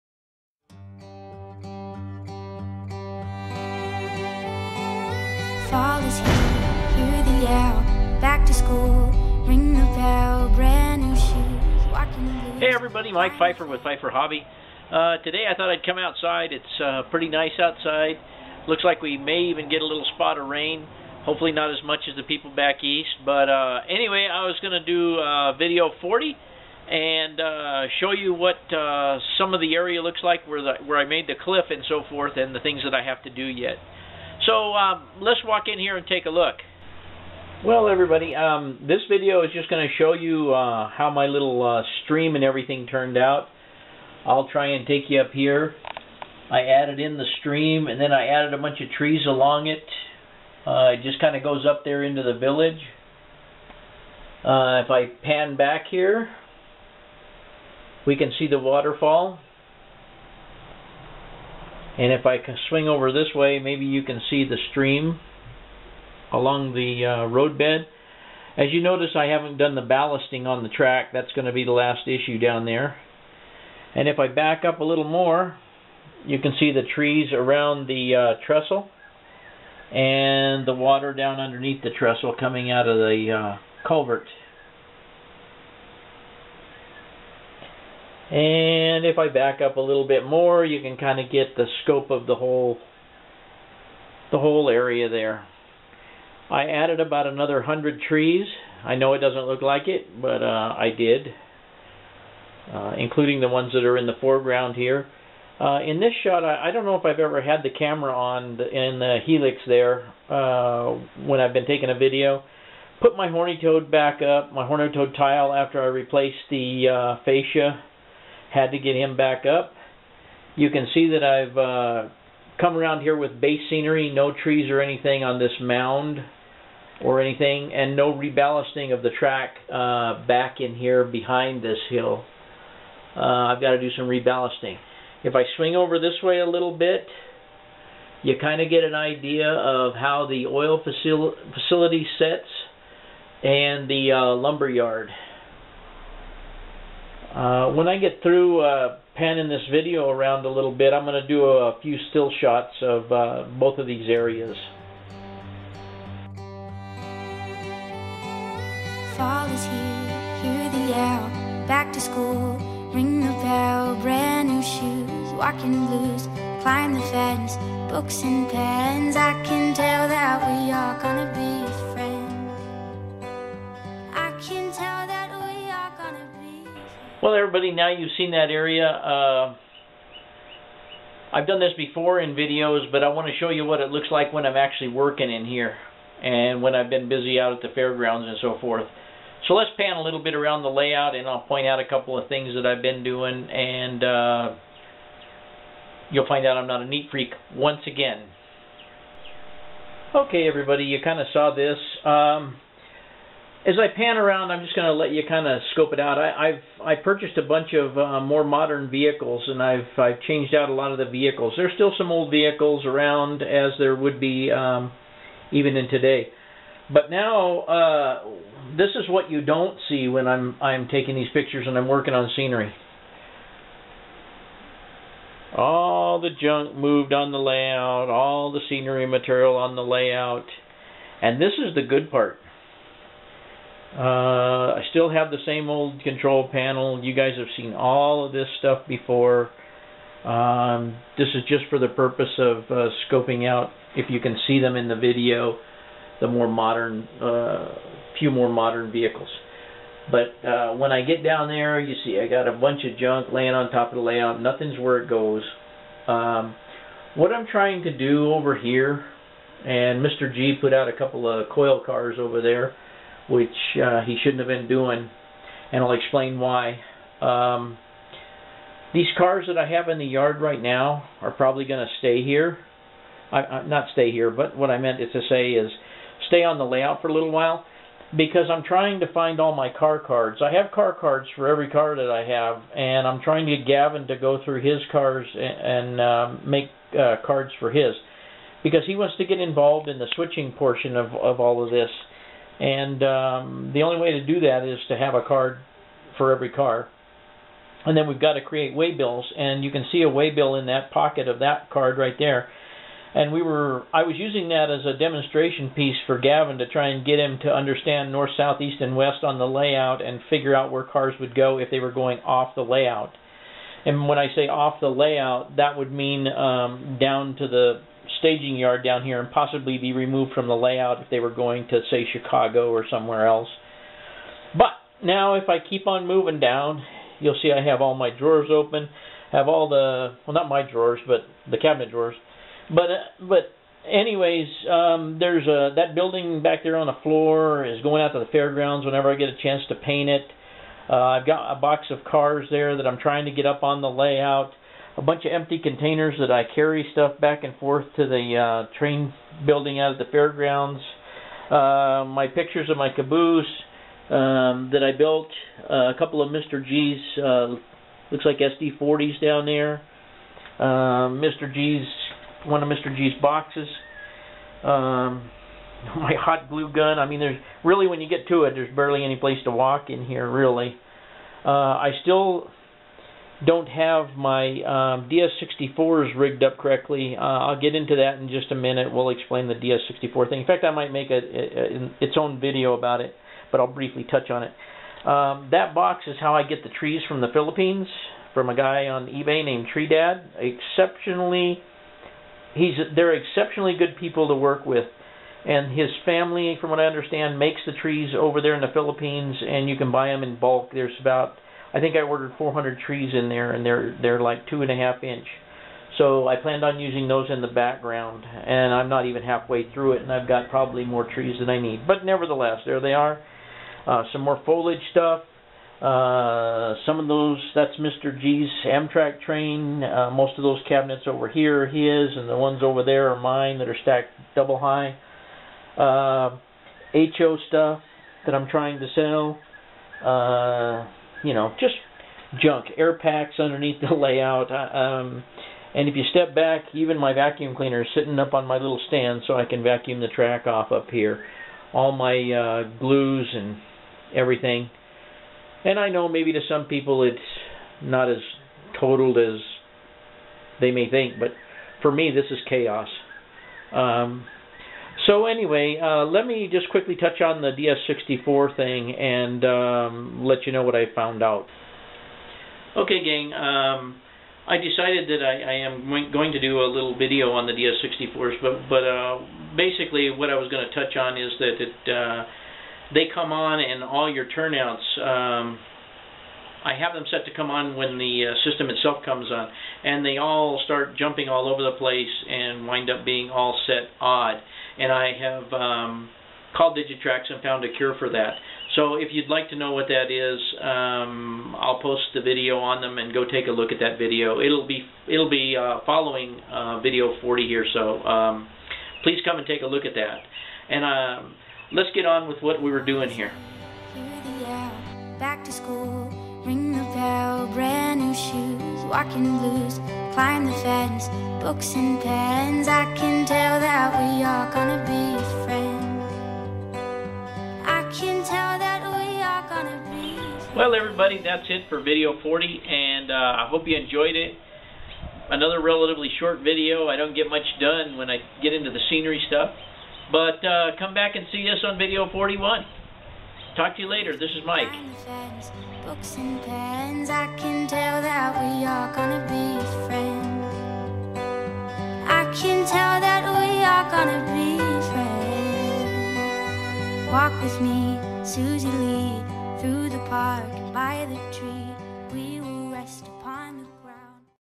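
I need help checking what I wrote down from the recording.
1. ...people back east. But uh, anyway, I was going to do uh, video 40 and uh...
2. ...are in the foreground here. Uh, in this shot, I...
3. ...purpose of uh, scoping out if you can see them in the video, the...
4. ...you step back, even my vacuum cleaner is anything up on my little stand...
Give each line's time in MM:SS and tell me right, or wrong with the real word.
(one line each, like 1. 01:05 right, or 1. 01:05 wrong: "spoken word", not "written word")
1. 00:22 right
2. 01:43 right
3. 04:01 right
4. 07:15 wrong: "sitting", not "anything".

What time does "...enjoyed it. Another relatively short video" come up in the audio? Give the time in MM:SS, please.
08:43.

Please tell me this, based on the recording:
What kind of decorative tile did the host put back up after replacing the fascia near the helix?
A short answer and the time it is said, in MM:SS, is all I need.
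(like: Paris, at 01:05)
horny toad tile, at 01:54.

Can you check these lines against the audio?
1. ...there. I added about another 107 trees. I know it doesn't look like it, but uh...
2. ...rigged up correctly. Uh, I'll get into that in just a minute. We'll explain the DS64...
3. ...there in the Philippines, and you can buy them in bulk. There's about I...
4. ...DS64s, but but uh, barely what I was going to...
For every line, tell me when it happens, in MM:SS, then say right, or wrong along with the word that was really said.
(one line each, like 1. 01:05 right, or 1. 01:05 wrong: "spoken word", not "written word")
1. 01:35 wrong: "100", not "107"
2. 06:16 right
3. 06:38 right
4. 07:47 wrong: "basically", not "barely".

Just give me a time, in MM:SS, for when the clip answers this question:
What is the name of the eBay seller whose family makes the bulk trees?
06:29.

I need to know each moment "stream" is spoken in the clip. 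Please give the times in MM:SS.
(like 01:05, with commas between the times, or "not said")
00:42, 00:47, 01:04.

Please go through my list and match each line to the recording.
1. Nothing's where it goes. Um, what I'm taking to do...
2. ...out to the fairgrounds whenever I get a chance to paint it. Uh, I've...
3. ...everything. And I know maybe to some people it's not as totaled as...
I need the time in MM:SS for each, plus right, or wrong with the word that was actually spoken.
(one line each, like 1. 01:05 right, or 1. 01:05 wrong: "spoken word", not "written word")
1. 04:14 wrong: "trying", not "taking"
2. 05:38 right
3. 07:24 right.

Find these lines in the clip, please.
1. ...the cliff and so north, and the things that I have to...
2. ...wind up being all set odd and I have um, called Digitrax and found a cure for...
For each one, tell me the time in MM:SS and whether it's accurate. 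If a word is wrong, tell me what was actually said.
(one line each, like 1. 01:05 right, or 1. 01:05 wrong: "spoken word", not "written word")
1. 00:31 wrong: "forth", not "north"
2. 08:02 right.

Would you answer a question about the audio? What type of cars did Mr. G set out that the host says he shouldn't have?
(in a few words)
coil cars.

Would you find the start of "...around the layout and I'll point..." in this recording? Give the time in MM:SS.
03:10.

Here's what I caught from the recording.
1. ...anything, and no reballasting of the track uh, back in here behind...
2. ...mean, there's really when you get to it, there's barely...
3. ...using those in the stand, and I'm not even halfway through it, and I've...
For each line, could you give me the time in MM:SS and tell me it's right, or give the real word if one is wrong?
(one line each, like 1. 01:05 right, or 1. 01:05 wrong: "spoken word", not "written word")
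1. 02:07 right
2. 06:07 right
3. 06:46 wrong: "background", not "stand".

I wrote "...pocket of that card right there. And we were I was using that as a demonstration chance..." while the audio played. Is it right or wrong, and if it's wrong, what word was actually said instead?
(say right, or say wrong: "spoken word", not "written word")
wrong: "piece", not "chance".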